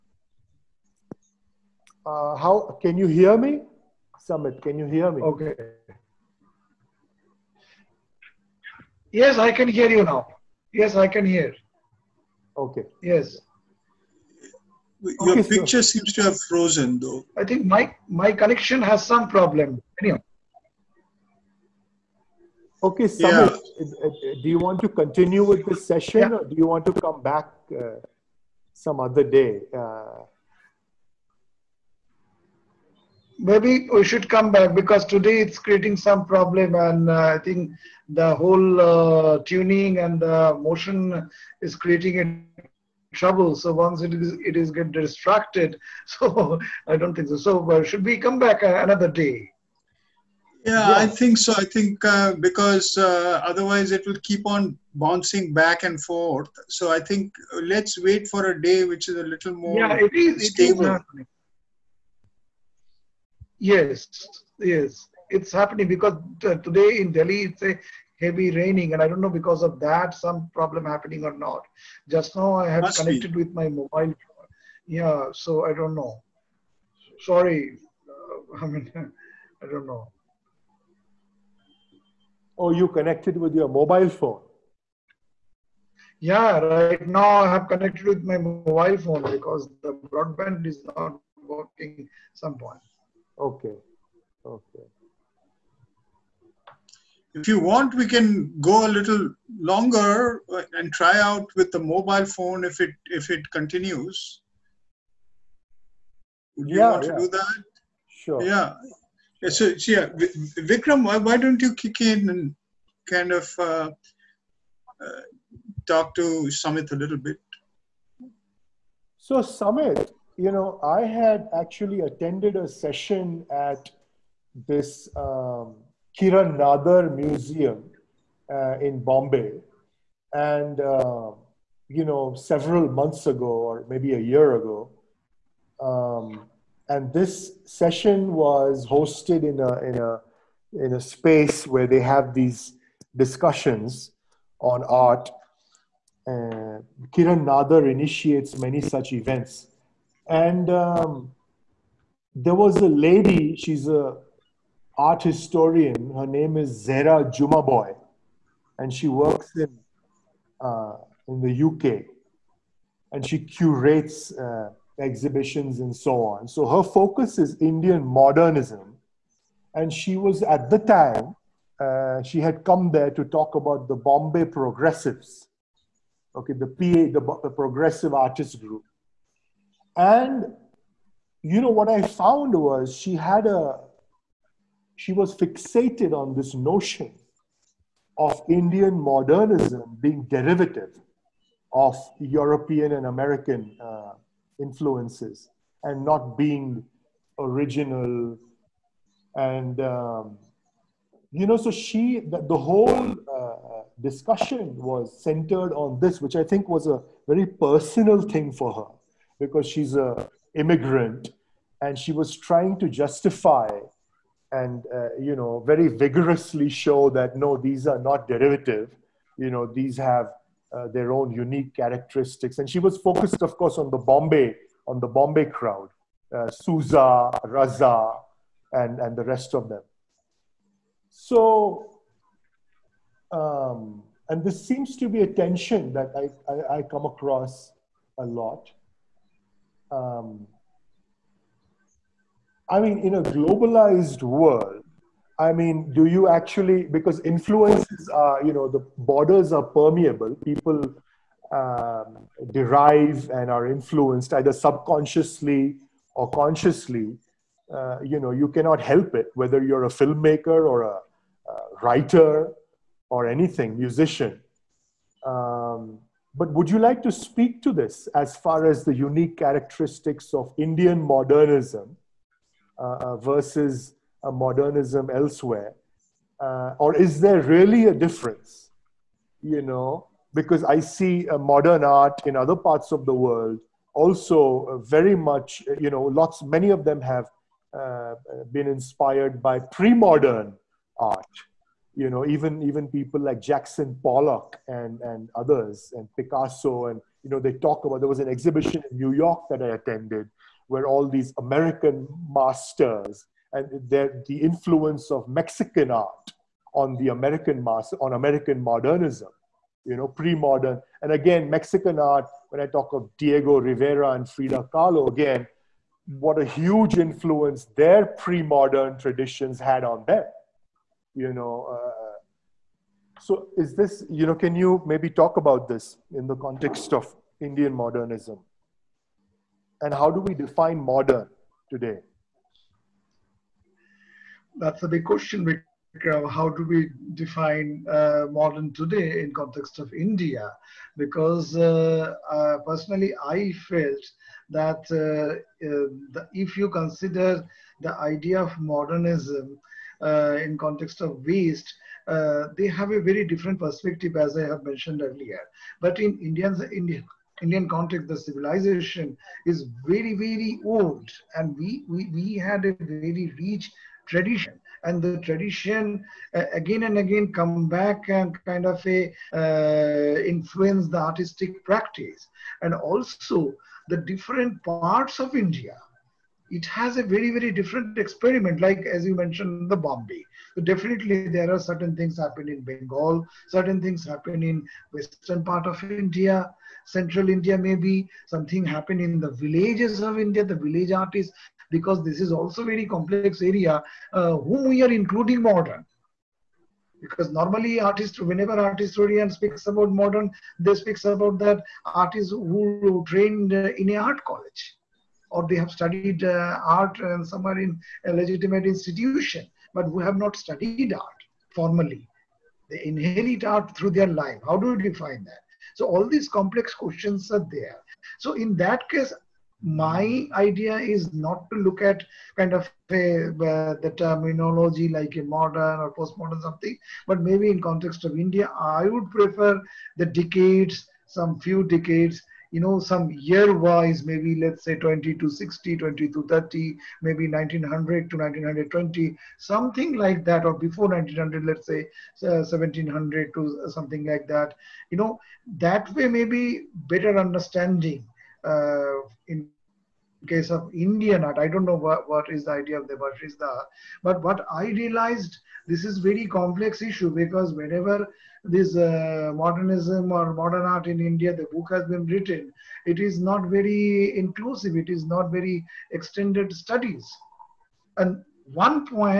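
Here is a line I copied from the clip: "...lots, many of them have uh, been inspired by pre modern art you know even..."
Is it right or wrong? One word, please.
right.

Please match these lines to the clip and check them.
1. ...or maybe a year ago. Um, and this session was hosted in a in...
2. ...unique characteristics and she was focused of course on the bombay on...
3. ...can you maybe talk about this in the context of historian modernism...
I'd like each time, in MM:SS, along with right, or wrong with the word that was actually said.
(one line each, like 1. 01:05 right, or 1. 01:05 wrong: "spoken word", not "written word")
1. 02:13 right
2. 03:41 right
3. 05:24 wrong: "indian", not "historian".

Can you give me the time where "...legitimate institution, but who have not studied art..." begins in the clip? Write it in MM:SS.
06:48.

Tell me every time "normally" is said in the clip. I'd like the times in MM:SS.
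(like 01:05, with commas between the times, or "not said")
06:37.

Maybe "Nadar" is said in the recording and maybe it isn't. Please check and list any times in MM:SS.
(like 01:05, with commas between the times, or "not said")
02:06, 02:27.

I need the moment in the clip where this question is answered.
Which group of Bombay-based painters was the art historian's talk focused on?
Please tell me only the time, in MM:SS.
02:57.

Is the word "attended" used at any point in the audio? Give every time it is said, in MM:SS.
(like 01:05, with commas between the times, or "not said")
02:01, 04:59.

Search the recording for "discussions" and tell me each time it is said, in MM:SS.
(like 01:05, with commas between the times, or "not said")
02:23, 03:23.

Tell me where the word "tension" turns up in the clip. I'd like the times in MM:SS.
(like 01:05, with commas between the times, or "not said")
03:55.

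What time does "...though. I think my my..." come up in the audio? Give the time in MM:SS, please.
00:16.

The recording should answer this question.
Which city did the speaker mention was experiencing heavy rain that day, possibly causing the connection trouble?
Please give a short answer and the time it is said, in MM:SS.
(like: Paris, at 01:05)
Delhi, at 01:07.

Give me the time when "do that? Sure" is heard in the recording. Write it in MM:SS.
01:47.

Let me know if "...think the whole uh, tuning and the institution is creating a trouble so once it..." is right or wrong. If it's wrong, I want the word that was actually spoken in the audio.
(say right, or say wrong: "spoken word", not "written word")
wrong: "motion", not "institution".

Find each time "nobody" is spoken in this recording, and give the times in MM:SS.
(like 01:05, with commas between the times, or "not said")
not said.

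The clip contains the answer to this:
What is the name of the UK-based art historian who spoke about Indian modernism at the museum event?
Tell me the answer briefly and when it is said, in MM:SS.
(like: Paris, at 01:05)
Zehra Jumabhoy, at 02:36.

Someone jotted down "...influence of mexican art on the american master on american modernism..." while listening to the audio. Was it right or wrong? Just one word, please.
right.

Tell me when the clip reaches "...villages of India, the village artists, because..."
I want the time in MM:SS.
06:29.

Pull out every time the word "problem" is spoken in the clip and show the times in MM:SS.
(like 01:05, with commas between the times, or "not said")
00:19, 00:36, 01:10.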